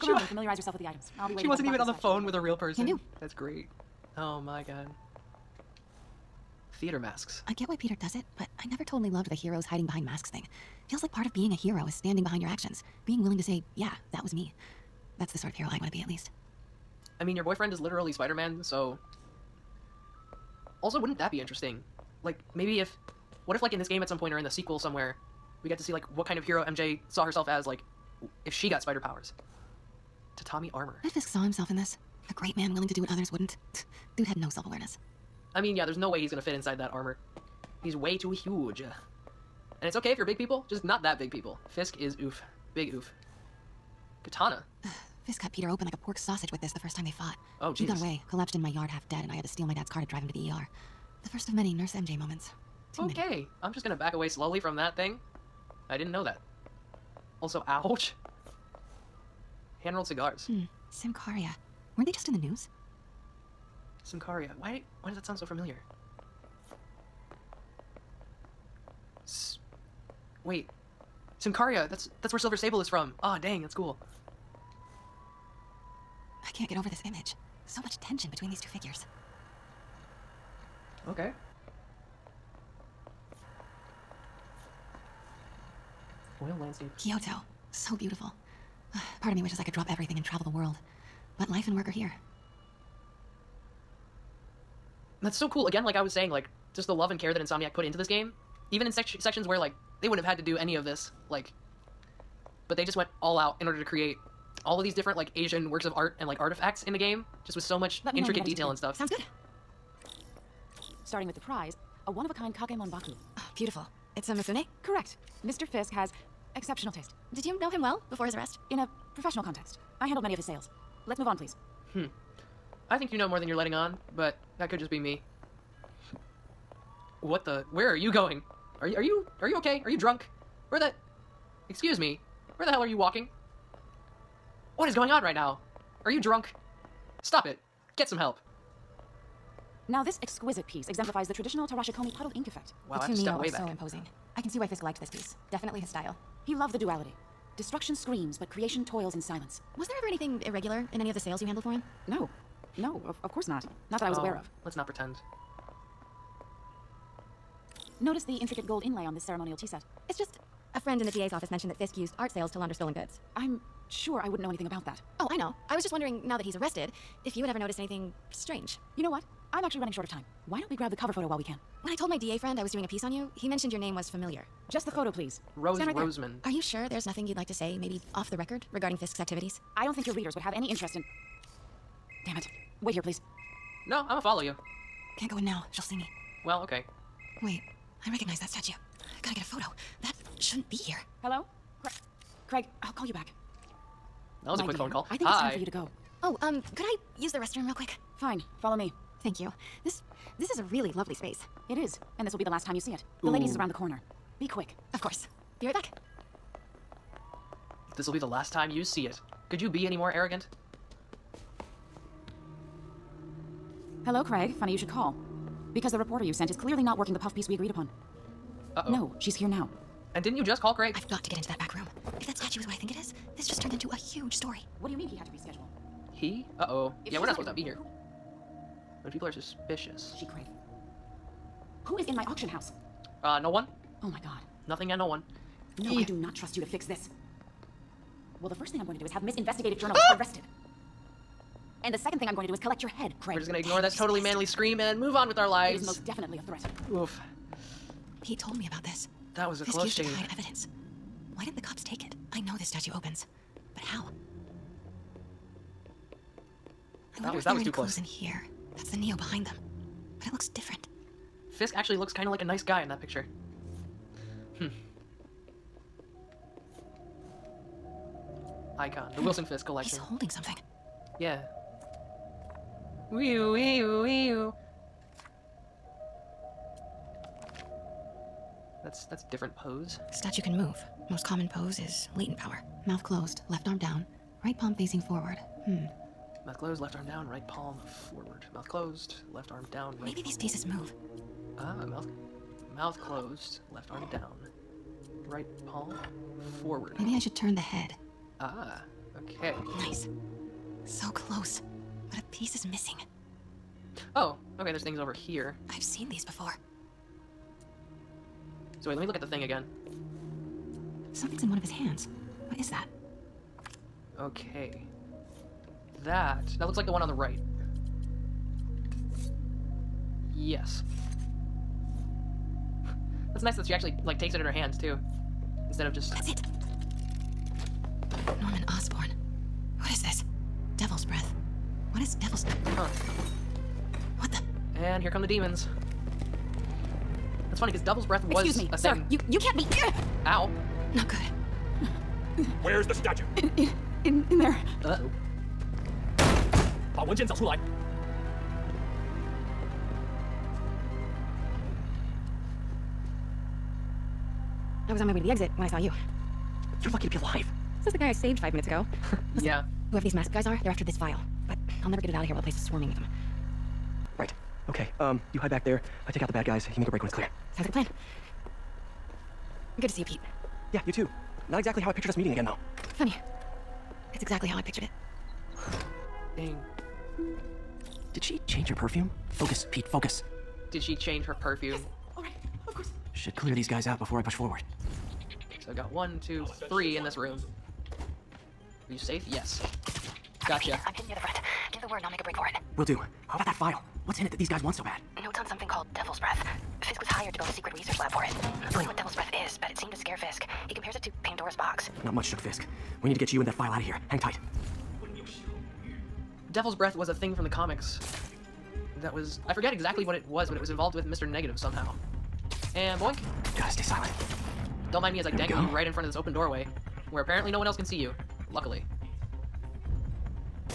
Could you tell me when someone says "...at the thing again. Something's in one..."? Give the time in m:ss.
5:09.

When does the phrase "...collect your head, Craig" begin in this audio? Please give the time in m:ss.
4:02.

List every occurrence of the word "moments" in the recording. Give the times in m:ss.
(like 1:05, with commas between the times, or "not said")
0:52.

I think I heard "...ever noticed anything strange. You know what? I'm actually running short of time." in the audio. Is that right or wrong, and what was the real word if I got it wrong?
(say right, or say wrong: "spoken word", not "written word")
right.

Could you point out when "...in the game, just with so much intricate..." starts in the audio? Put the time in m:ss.
1:46.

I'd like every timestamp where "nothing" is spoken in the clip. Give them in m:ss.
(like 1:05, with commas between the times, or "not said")
2:57, 3:54.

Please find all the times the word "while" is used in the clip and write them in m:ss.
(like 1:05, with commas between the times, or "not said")
2:51, 6:02.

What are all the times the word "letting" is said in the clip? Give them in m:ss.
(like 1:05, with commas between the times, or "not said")
2:03.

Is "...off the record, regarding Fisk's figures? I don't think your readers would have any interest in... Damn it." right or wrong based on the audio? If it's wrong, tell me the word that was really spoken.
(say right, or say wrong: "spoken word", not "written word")
wrong: "activities", not "figures".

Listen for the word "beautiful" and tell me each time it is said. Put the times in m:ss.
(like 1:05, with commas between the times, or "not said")
1:27, 1:53.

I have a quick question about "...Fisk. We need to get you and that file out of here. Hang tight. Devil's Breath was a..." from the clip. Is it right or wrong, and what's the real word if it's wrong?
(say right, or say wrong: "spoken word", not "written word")
right.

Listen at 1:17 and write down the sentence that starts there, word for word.
So much tension between these two figures.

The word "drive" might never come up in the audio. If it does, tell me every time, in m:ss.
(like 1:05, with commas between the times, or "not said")
0:50.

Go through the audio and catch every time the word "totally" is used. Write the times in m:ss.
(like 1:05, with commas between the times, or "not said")
0:08, 4:03.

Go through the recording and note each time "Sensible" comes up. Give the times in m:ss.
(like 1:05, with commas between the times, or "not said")
not said.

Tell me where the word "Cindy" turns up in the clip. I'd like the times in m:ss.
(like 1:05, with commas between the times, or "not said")
not said.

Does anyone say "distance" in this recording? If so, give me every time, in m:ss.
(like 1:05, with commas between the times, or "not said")
not said.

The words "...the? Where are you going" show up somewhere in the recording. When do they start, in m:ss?
2:07.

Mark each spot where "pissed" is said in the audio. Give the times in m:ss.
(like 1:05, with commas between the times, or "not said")
4:04.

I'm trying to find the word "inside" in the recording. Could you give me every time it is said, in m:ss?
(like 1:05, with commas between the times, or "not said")
0:36.